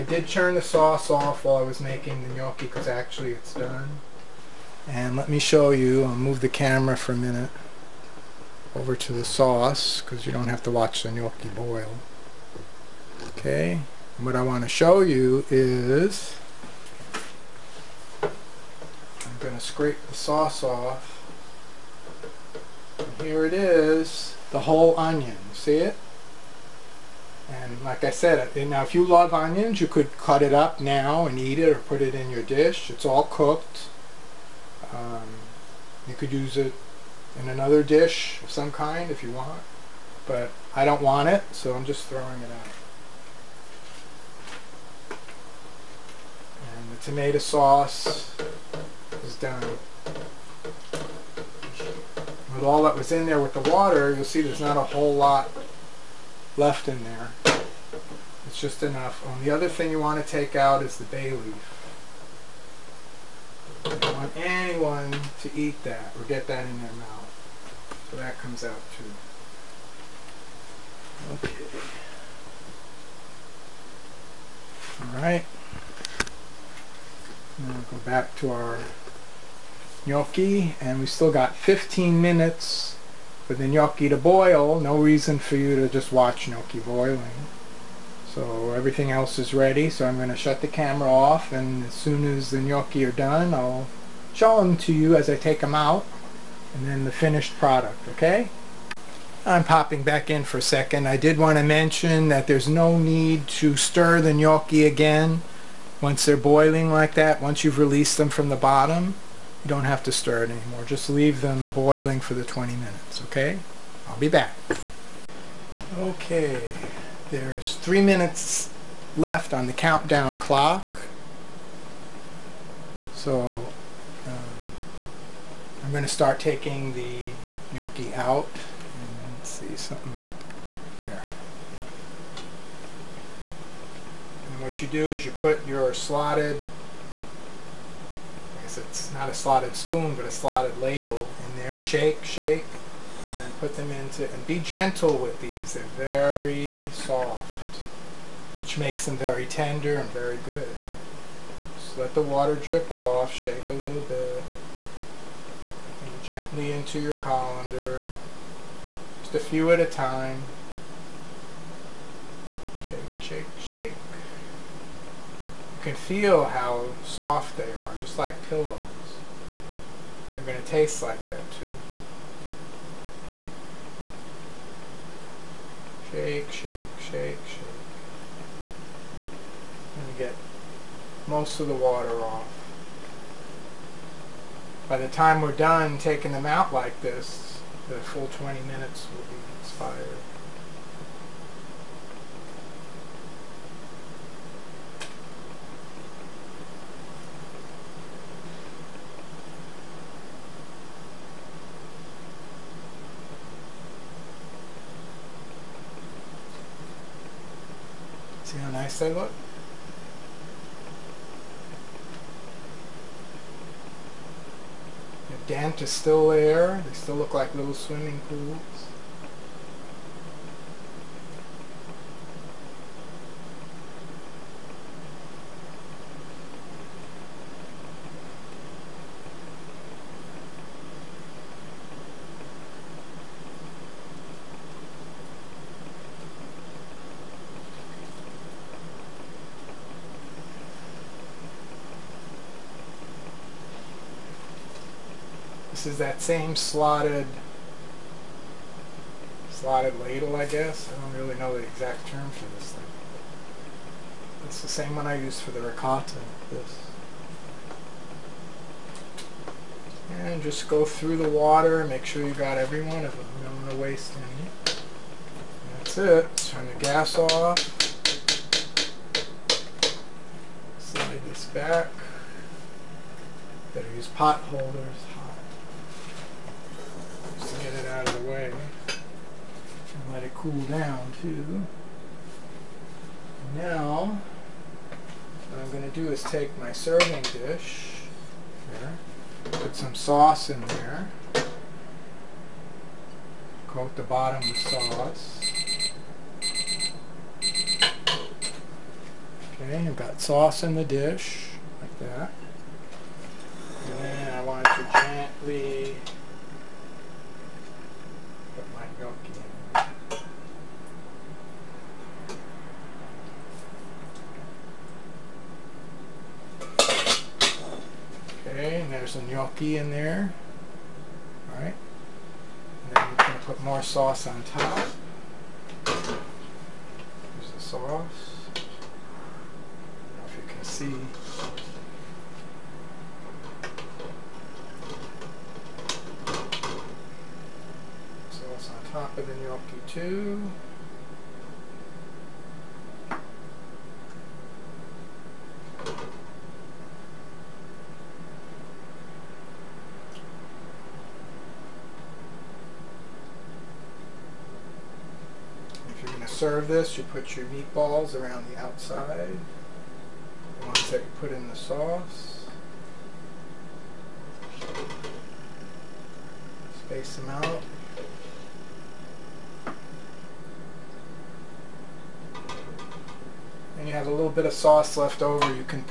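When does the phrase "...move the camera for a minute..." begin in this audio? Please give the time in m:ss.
0:06.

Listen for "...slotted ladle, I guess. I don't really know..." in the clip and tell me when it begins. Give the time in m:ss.
4:09.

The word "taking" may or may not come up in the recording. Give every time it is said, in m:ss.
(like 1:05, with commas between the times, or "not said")
2:06, 3:05.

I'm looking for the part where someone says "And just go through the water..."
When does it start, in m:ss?
4:20.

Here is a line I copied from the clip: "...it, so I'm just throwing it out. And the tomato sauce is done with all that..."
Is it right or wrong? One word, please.
right.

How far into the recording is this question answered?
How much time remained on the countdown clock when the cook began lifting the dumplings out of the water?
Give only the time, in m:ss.
1:57.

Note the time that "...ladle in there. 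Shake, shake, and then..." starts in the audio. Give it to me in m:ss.
2:20.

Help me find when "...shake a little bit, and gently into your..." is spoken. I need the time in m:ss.
2:33.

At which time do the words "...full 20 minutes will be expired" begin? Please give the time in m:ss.
3:07.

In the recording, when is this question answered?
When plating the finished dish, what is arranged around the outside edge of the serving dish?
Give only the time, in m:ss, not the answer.
5:57.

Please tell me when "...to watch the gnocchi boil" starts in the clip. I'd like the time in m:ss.
0:10.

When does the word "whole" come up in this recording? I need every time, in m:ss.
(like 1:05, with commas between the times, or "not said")
0:24, 0:54.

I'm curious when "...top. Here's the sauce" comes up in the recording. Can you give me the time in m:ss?
5:24.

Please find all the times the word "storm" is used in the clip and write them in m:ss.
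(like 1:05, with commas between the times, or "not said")
not said.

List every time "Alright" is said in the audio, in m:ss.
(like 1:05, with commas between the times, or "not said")
1:15, 5:21.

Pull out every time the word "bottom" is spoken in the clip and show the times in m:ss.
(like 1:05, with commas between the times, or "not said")
1:48, 4:54.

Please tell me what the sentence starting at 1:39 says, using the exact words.
I'm popping back in for a second.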